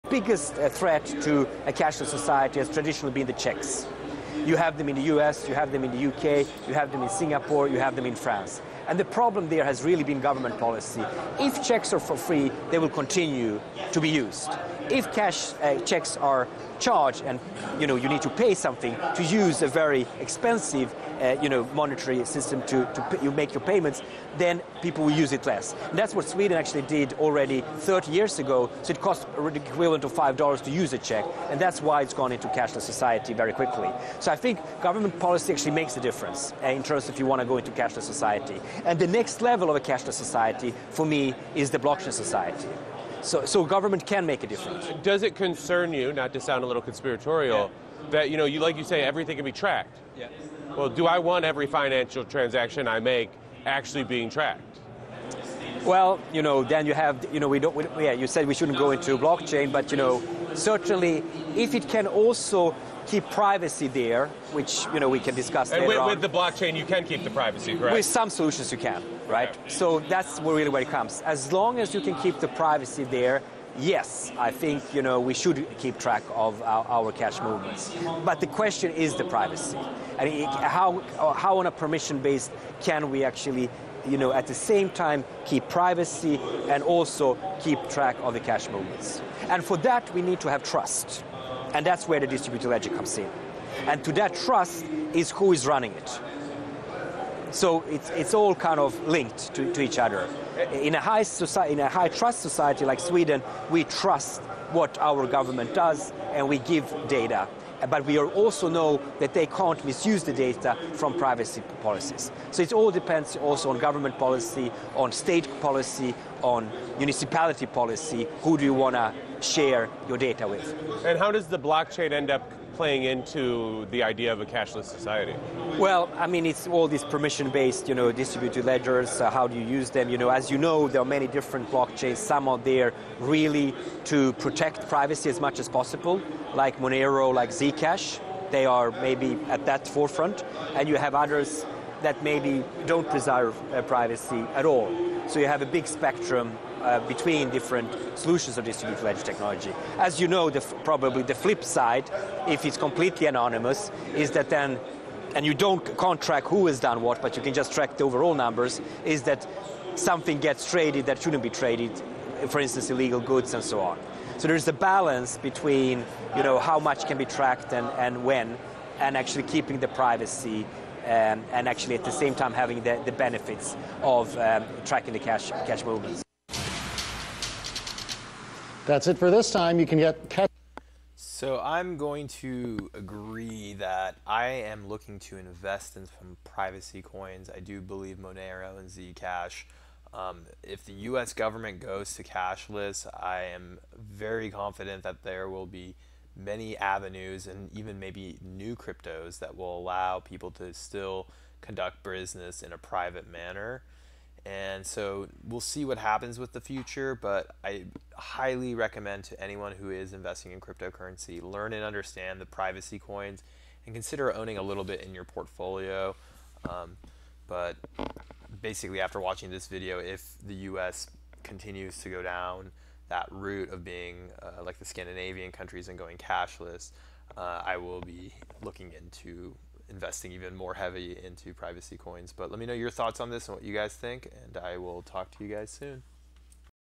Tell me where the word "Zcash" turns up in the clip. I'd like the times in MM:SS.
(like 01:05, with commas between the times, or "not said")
02:17, 03:08.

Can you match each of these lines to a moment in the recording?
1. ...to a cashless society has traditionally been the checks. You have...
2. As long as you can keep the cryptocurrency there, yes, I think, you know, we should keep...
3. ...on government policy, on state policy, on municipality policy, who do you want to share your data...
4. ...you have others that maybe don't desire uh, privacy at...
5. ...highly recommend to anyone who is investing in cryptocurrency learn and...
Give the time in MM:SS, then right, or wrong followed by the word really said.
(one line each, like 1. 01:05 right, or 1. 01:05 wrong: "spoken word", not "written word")
1. 00:01 right
2. 01:11 wrong: "privacy", not "cryptocurrency"
3. 01:53 right
4. 02:20 right
5. 03:28 right.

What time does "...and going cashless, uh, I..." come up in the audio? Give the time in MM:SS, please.
03:45.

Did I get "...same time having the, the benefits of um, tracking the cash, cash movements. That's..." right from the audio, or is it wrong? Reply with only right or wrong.
right.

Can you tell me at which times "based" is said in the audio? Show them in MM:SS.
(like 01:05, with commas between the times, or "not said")
01:21, 02:07.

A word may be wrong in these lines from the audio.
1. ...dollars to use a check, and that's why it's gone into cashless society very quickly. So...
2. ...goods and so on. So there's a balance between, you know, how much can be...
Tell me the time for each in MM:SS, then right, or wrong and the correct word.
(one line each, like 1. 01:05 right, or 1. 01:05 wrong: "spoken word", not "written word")
1. 00:30 right
2. 02:43 right.